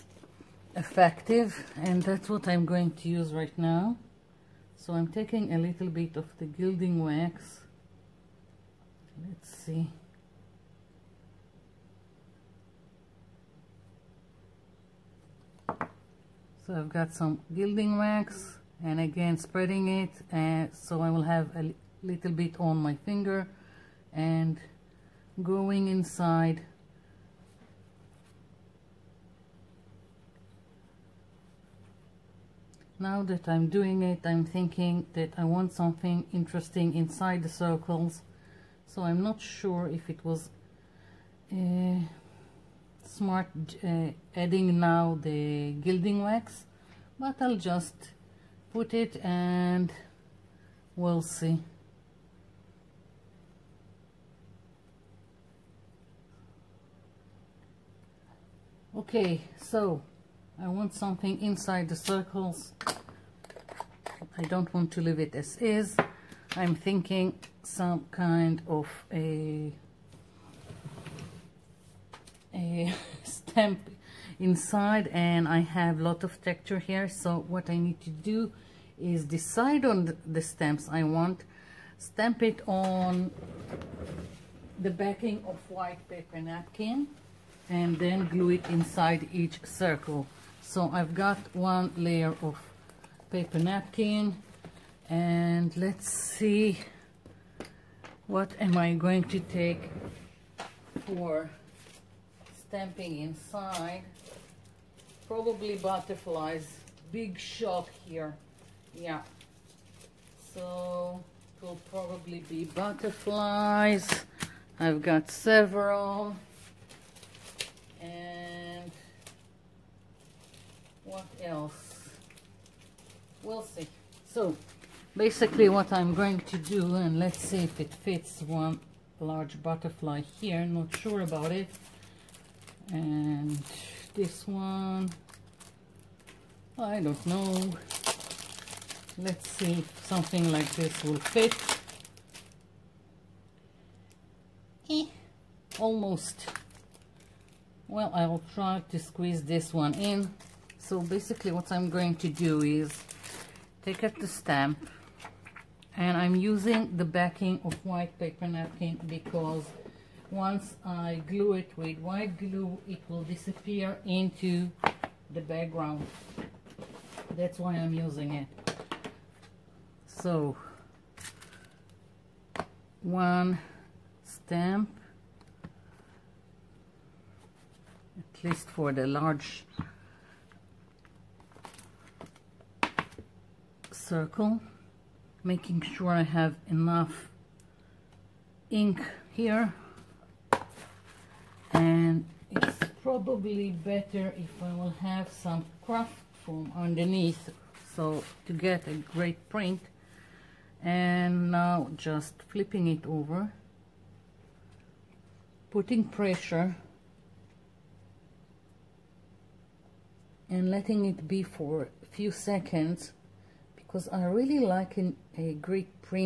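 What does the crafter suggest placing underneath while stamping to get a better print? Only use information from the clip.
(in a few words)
craft foam.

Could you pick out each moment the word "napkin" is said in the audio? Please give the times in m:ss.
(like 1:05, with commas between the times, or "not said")
1:26, 1:33, 2:38.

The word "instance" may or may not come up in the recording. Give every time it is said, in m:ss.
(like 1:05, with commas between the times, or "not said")
not said.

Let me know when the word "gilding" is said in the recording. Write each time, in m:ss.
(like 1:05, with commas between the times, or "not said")
0:06, 0:17, 0:45.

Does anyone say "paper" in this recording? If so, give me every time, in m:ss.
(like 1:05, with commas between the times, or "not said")
1:26, 1:33, 2:38.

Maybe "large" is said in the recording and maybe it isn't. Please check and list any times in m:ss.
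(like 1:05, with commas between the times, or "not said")
2:09, 2:59.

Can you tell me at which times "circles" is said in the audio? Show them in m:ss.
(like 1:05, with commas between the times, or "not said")
0:37, 1:01, 1:29, 3:03.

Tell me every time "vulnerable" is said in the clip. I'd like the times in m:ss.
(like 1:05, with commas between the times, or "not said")
not said.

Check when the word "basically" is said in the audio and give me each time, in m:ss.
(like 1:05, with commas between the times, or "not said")
2:05, 2:31.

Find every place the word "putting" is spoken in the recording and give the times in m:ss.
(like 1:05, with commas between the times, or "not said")
3:25.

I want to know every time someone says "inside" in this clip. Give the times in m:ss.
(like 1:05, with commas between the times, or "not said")
0:25, 0:36, 1:01, 1:14, 1:28, 1:43.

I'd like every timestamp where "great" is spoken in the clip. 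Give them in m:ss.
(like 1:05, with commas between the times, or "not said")
3:19, 3:35.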